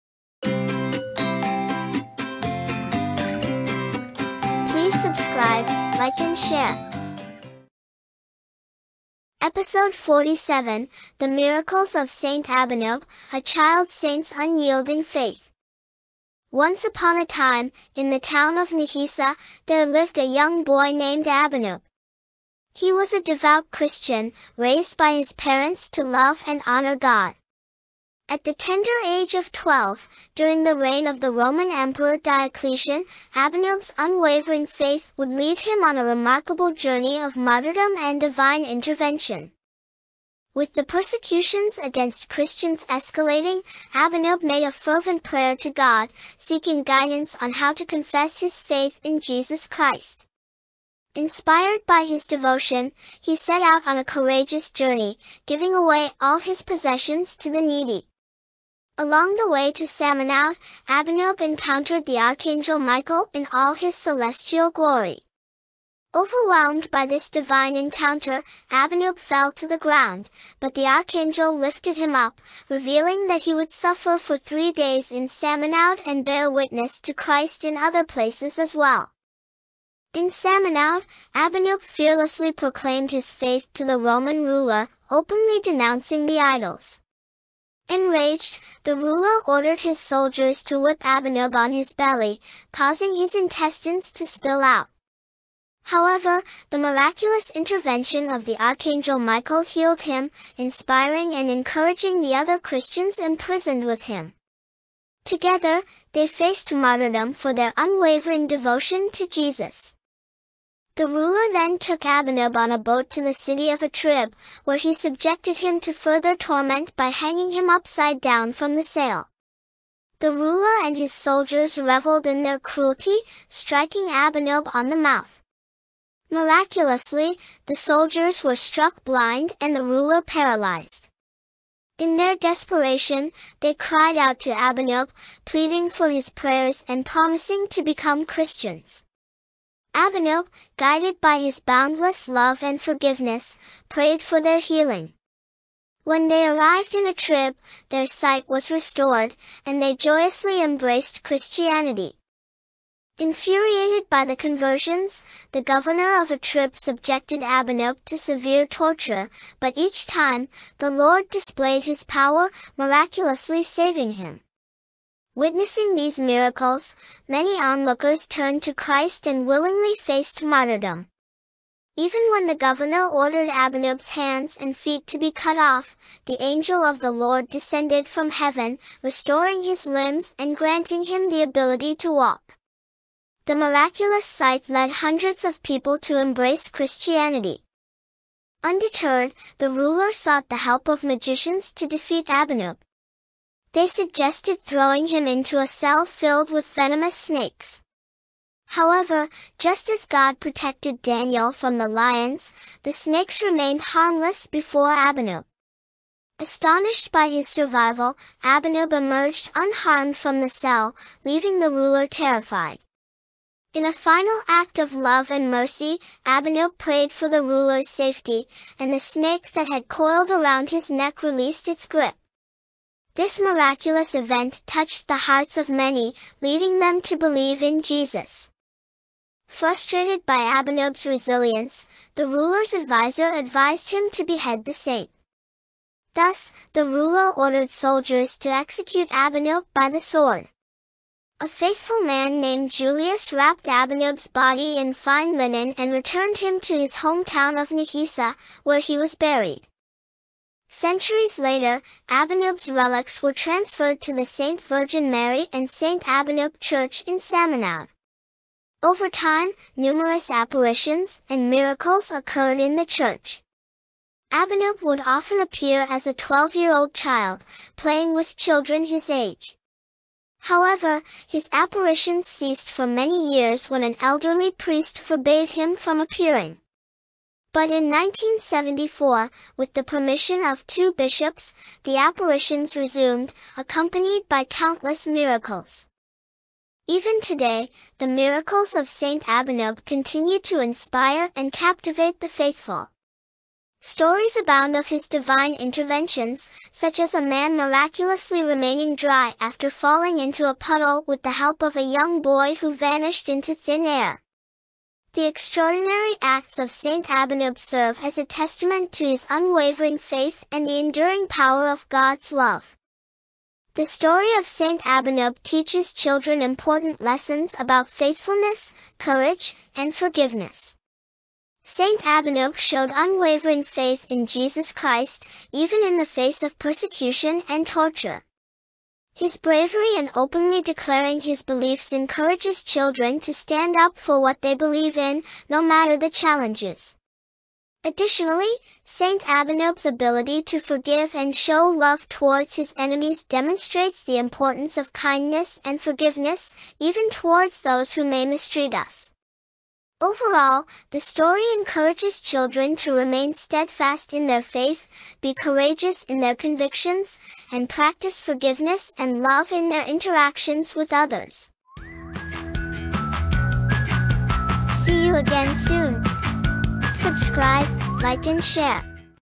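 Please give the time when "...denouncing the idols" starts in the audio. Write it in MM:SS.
01:25.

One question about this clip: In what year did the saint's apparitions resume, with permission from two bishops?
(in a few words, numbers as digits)
1974.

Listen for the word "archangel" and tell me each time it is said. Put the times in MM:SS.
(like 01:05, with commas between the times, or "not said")
01:02, 01:10, 01:38.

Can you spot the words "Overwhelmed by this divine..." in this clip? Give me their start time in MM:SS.
01:06.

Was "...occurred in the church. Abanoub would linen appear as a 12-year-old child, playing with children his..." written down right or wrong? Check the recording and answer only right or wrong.
wrong.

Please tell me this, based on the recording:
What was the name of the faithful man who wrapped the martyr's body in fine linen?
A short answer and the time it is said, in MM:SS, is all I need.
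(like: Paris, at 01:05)
Julius, at 04:02.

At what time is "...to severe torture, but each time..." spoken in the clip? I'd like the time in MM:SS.
02:38.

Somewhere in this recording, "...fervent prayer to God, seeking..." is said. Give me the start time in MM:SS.
00:44.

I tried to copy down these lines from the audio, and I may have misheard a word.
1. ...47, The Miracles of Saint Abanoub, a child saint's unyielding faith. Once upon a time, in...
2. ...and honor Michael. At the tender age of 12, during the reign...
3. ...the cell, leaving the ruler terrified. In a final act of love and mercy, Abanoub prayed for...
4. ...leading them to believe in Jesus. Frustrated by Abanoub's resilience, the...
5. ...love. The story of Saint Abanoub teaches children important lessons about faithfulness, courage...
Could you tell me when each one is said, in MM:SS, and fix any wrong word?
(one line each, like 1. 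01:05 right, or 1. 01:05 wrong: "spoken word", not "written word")
1. 00:09 right
2. 00:26 wrong: "God", not "Michael"
3. 03:30 right
4. 03:46 right
5. 05:12 right.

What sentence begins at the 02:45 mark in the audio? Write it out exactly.
Witnessing these miracles, many onlookers turned to Christ and willingly faced martyrdom.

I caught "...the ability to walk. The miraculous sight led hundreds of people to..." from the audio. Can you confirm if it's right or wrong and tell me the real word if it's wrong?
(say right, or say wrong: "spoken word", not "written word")
right.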